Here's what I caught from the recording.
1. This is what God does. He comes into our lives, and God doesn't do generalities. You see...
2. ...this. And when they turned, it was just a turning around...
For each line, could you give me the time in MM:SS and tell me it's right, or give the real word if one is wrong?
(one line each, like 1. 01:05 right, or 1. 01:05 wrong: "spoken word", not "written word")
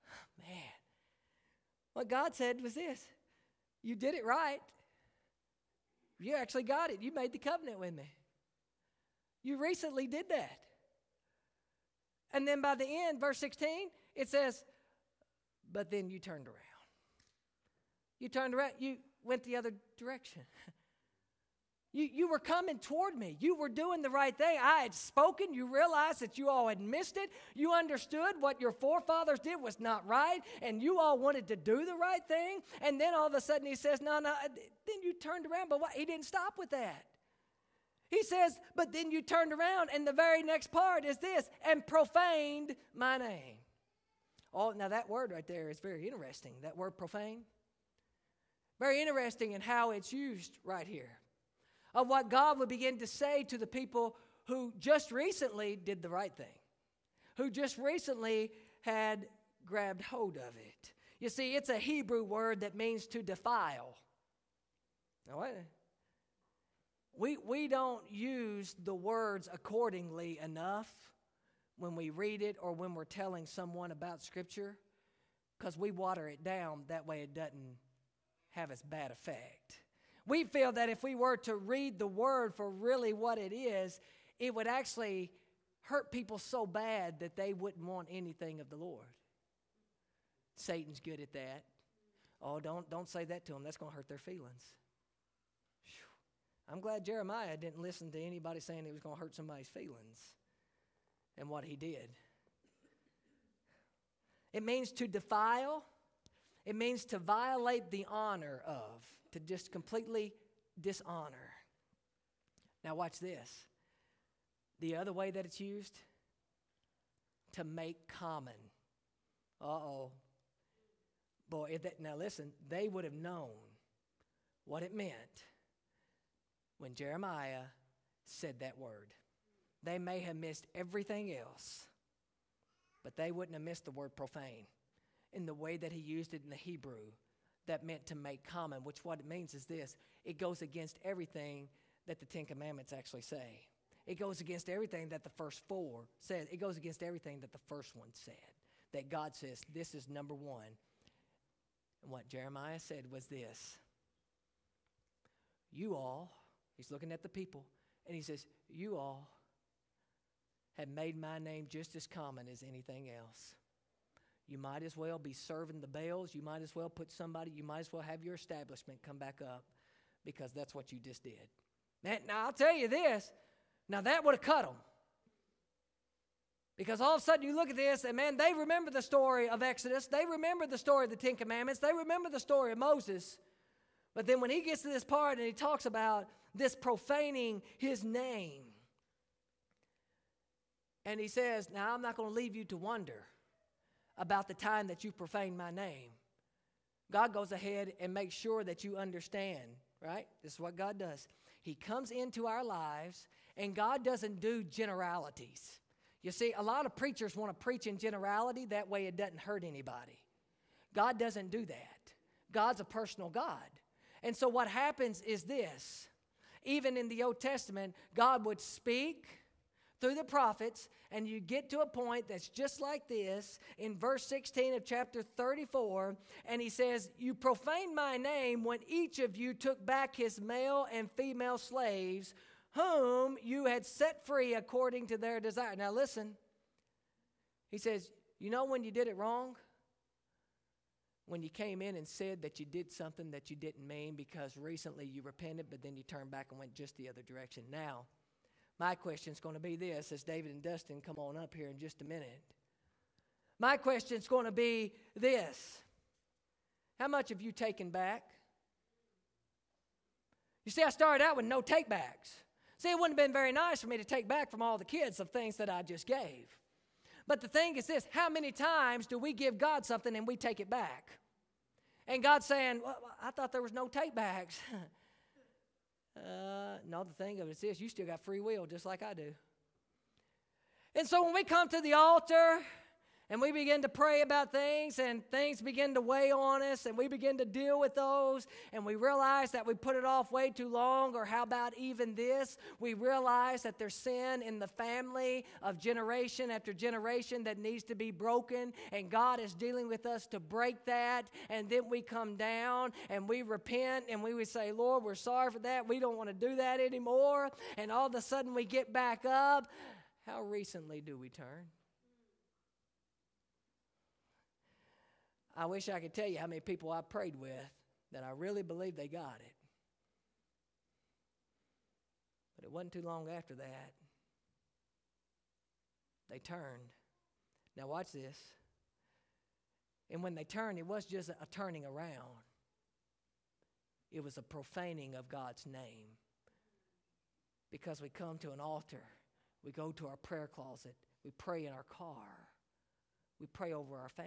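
1. 03:20 right
2. 05:28 right.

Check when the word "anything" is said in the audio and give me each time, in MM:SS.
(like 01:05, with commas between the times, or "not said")
01:28, 02:42.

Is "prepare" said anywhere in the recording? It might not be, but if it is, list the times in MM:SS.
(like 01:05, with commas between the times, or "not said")
not said.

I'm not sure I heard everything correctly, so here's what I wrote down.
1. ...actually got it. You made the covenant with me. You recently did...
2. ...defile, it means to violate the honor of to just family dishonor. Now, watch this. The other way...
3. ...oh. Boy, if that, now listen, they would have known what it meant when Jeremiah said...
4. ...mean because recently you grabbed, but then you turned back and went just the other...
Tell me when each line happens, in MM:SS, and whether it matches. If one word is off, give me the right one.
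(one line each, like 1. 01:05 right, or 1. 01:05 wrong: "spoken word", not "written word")
1. 00:06 right
2. 01:45 wrong: "completely", not "family"
3. 01:59 right
4. 04:03 wrong: "repented", not "grabbed".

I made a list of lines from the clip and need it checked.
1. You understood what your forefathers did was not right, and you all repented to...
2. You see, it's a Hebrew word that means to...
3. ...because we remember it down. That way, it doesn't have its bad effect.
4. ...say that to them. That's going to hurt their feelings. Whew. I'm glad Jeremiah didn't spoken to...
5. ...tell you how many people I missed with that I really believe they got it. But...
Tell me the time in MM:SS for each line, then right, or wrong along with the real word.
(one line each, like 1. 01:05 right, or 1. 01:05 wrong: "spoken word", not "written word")
1. 00:27 wrong: "wanted", not "repented"
2. 01:01 right
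3. 01:15 wrong: "water", not "remember"
4. 01:33 wrong: "listen", not "spoken"
5. 05:16 wrong: "prayed", not "missed".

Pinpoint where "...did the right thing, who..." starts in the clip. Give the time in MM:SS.
00:55.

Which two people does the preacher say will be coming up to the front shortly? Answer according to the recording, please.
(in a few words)
David and Dustin.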